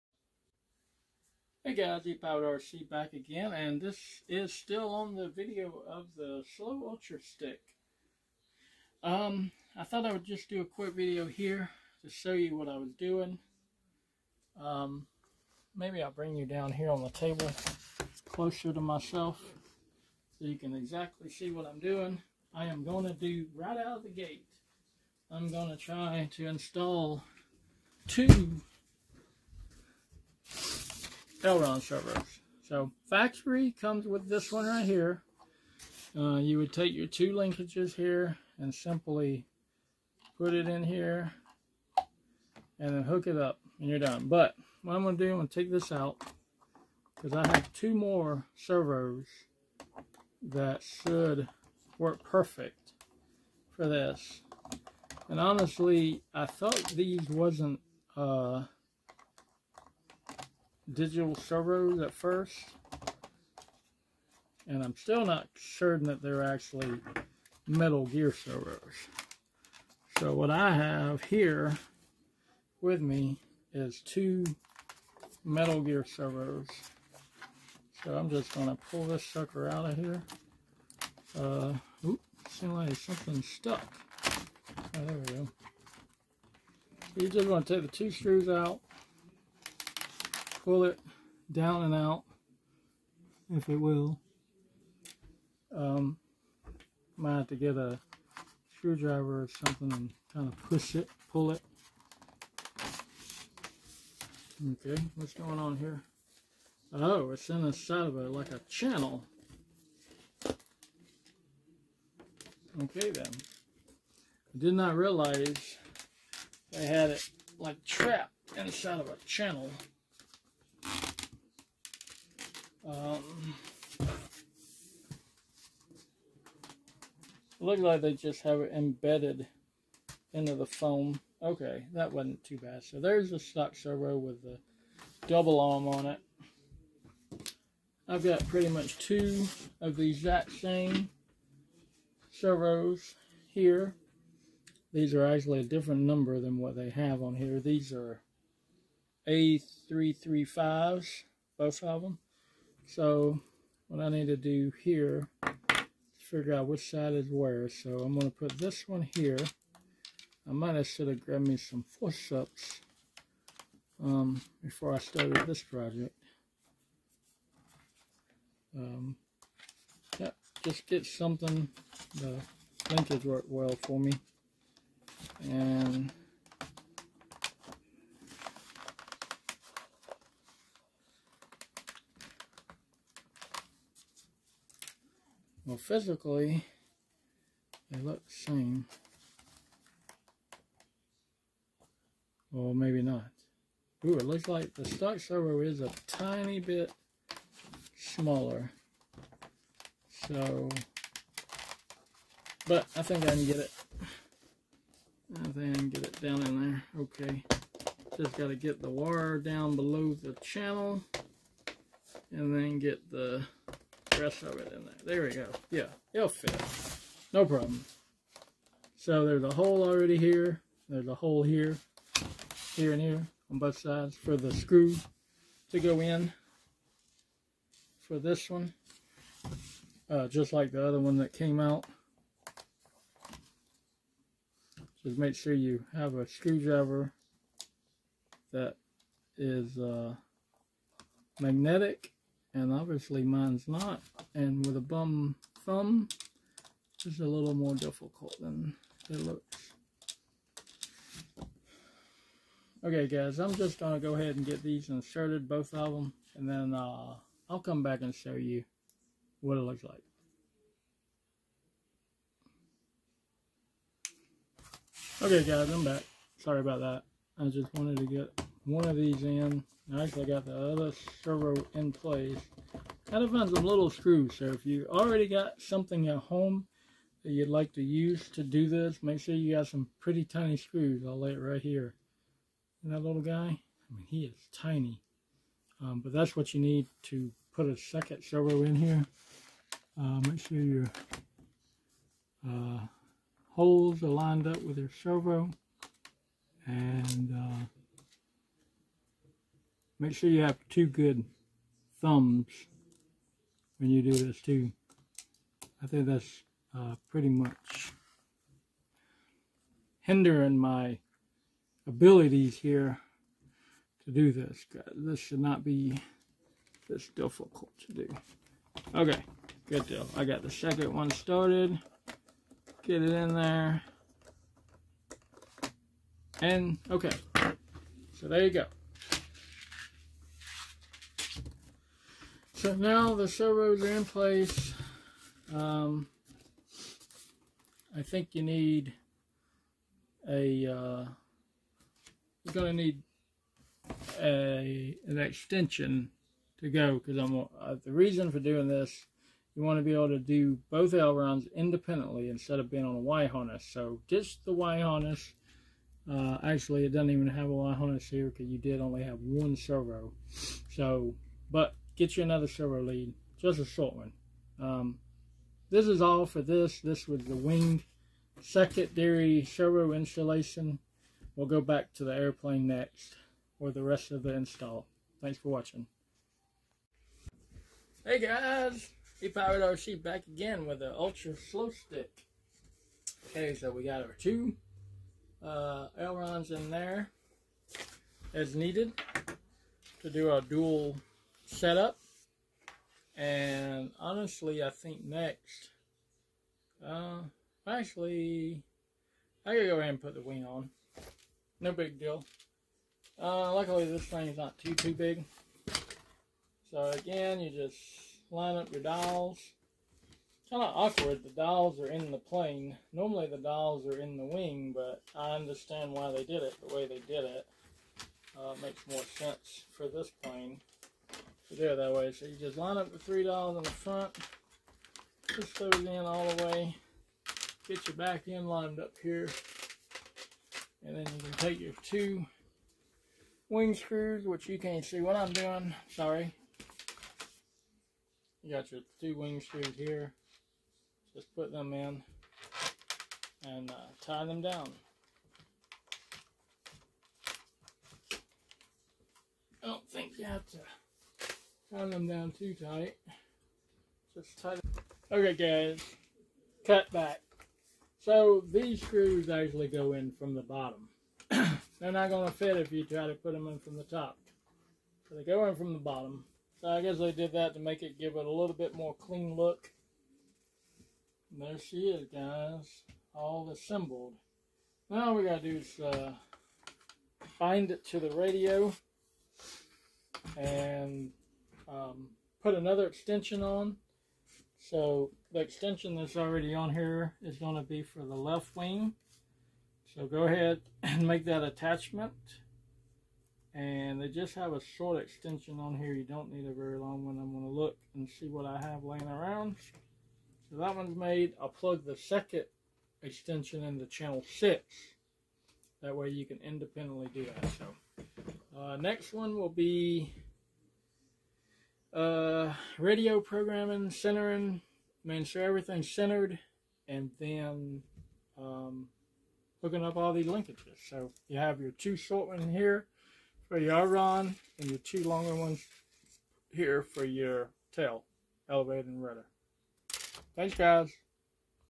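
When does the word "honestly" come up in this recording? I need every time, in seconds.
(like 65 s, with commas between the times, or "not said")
55 s, 393 s.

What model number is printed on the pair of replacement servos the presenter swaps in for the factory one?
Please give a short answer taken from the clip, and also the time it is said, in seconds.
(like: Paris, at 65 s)
A335, at 149 s.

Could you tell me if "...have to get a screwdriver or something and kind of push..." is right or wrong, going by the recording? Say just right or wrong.
right.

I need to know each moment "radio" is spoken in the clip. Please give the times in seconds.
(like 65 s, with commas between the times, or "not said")
478 s, 512 s.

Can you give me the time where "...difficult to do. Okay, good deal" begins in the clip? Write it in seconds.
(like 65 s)
317 s.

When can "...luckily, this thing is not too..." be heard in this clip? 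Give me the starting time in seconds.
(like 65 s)
403 s.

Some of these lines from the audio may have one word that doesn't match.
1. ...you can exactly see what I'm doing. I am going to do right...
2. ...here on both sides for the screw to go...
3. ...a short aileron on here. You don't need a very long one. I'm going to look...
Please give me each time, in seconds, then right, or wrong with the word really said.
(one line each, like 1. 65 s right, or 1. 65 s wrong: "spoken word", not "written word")
1. 20 s right
2. 223 s right
3. 494 s wrong: "extension", not "aileron".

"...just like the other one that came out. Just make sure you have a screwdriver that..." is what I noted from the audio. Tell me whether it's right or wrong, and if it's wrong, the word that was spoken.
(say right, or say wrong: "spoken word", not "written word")
right.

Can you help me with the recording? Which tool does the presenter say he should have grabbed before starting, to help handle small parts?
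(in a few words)
Forceps.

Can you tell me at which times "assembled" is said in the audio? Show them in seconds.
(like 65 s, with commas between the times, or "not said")
473 s.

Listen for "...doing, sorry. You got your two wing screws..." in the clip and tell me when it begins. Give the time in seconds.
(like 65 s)
435 s.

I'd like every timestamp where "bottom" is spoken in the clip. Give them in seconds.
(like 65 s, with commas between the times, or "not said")
460 s, 465 s.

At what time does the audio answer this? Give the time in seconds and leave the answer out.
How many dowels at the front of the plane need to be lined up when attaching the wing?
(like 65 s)
422 s.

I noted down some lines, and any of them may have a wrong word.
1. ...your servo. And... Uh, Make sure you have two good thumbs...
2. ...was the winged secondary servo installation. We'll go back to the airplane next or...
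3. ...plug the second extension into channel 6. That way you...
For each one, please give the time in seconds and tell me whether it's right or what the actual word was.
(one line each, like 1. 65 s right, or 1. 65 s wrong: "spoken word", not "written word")
1. 294 s right
2. 367 s right
3. 501 s right.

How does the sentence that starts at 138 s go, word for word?
I've got pretty much two of the exact same servos here.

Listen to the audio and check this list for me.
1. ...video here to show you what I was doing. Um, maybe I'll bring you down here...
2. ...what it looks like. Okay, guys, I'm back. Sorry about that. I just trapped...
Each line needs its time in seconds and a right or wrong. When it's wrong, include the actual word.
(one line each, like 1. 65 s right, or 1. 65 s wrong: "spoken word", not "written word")
1. 10 s right
2. 259 s wrong: "wanted", not "trapped".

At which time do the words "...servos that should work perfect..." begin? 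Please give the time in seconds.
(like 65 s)
48 s.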